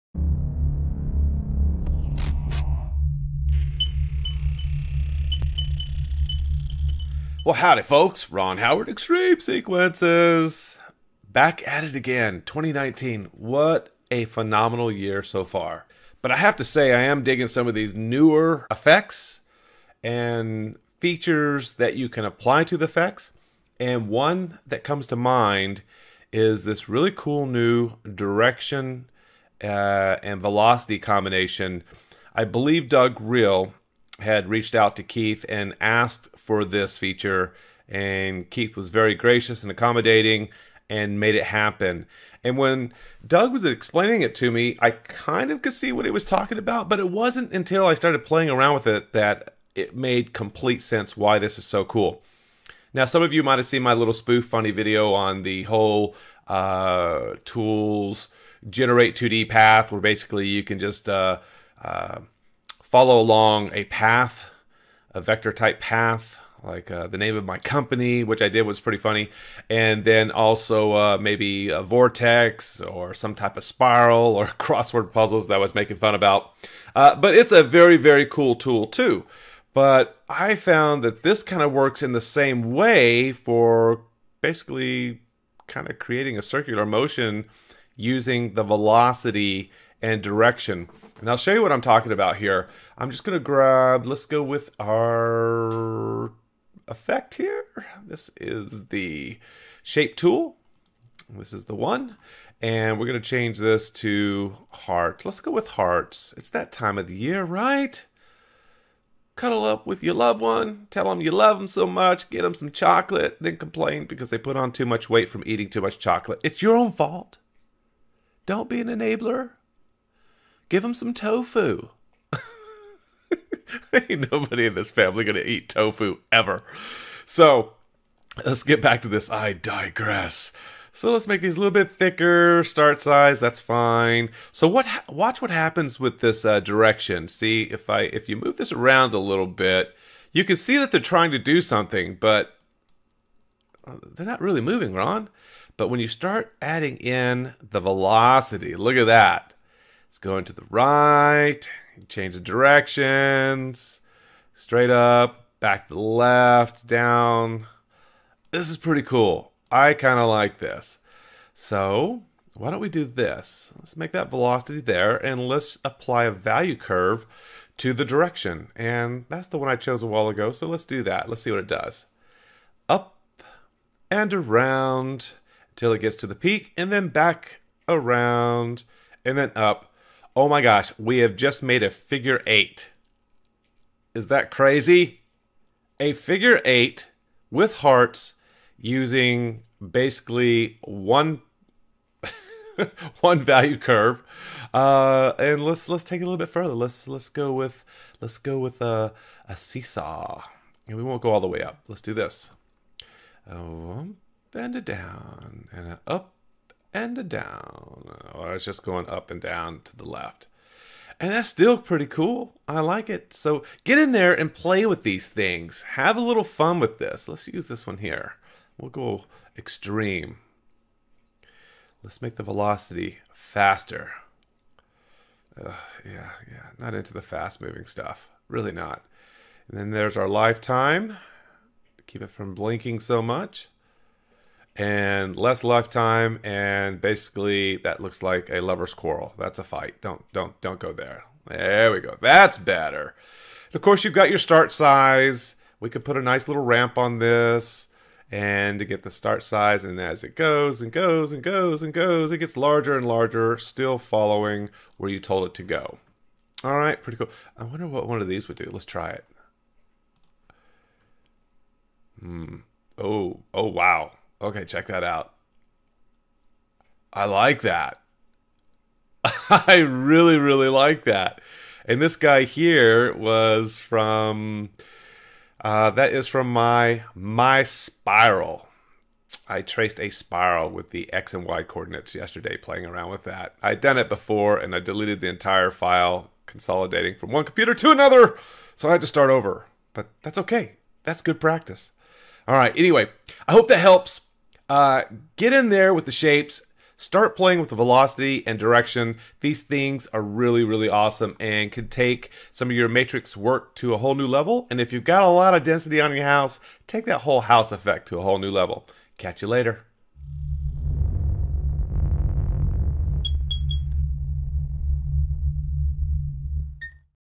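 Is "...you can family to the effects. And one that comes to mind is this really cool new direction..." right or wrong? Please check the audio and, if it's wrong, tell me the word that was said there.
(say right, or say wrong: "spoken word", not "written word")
wrong: "apply", not "family".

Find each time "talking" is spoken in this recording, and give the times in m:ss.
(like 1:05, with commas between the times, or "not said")
0:46, 1:31.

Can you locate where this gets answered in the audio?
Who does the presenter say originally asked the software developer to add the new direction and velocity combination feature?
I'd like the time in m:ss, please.
0:32.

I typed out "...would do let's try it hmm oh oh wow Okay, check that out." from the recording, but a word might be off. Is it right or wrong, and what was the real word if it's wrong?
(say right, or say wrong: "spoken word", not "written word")
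right.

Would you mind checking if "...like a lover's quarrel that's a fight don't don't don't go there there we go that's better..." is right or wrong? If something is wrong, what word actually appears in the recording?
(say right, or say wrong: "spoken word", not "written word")
right.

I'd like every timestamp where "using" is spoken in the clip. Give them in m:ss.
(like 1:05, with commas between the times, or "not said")
1:27, 3:08.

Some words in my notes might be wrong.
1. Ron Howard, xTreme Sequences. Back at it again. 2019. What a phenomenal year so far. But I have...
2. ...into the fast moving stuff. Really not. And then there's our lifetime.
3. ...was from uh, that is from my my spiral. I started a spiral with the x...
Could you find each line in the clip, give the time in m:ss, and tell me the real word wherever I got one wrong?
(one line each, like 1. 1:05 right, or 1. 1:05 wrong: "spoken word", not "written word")
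1. 0:08 right
2. 3:46 right
3. 4:33 wrong: "traced", not "started".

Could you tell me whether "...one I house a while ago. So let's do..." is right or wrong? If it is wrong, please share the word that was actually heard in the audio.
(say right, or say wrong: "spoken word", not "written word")
wrong: "chose", not "house".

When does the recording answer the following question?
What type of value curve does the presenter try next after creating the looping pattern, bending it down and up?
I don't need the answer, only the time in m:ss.
3:19.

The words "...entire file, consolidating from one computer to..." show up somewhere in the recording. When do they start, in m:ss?
4:45.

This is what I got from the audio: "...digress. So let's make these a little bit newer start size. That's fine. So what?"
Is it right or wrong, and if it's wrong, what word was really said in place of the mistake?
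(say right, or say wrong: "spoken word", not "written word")
wrong: "thicker", not "newer".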